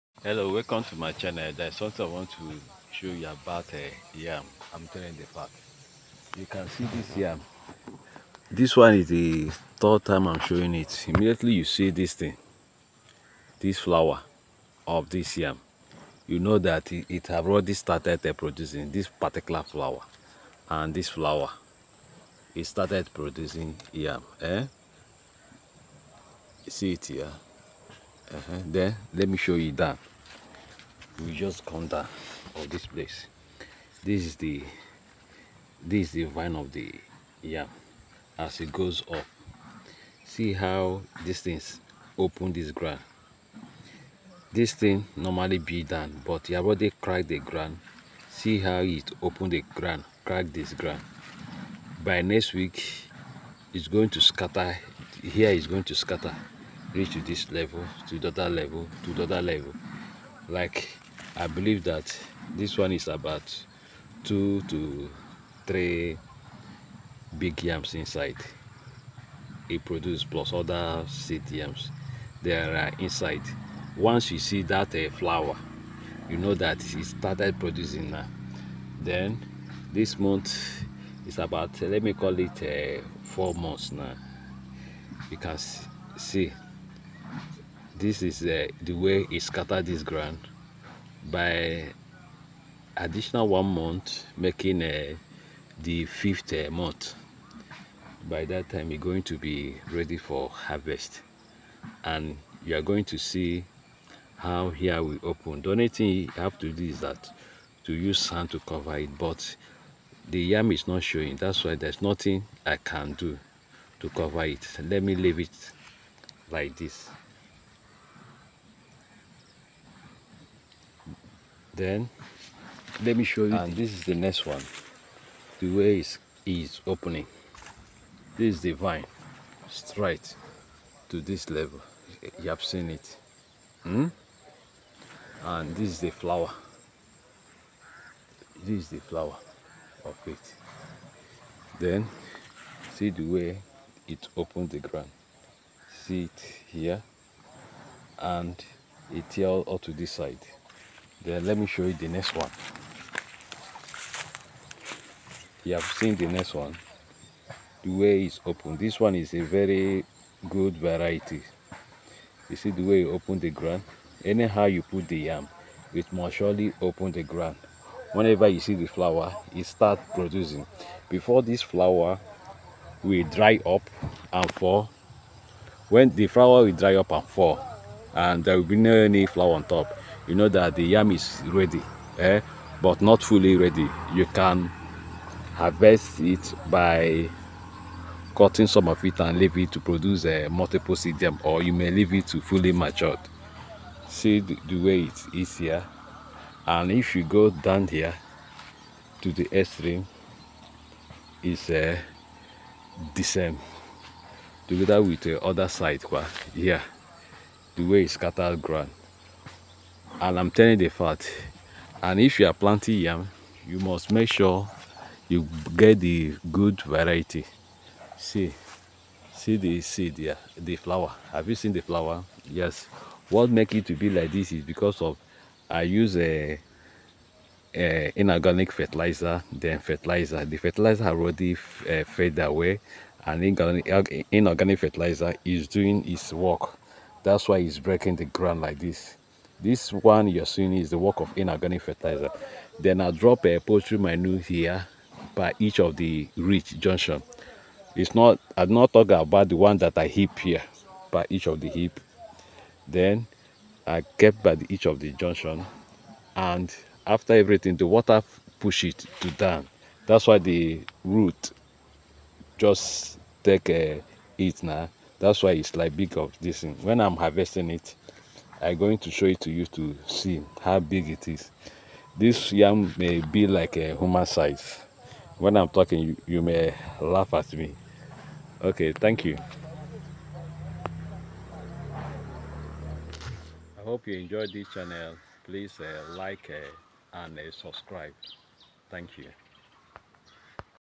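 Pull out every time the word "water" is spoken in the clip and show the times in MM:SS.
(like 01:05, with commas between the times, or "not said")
04:17.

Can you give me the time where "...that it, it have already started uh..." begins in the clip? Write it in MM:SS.
00:16.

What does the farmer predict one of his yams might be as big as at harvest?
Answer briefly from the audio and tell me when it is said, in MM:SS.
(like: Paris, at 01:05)
human size, at 04:33.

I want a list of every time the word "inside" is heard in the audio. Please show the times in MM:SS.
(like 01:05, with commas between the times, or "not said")
01:07, 01:12.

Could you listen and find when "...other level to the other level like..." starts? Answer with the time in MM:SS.
00:58.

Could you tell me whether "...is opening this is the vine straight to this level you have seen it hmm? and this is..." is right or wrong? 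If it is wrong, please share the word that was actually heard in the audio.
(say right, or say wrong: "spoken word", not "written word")
right.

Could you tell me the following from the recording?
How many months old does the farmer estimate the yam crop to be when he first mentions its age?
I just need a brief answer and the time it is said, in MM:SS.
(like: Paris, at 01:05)
4 months, at 01:23.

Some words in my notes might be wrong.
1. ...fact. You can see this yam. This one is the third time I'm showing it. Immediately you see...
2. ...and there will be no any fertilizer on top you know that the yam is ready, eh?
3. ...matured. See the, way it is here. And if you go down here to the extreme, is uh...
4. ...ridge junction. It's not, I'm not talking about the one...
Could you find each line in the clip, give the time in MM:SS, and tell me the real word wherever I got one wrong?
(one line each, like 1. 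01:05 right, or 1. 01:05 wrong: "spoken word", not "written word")
1. 00:05 right
2. 02:58 wrong: "flower", not "fertilizer"
3. 03:12 right
4. 04:06 right.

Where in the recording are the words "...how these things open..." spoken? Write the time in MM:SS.
00:40.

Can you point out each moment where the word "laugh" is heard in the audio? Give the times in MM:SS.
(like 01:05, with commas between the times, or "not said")
04:36.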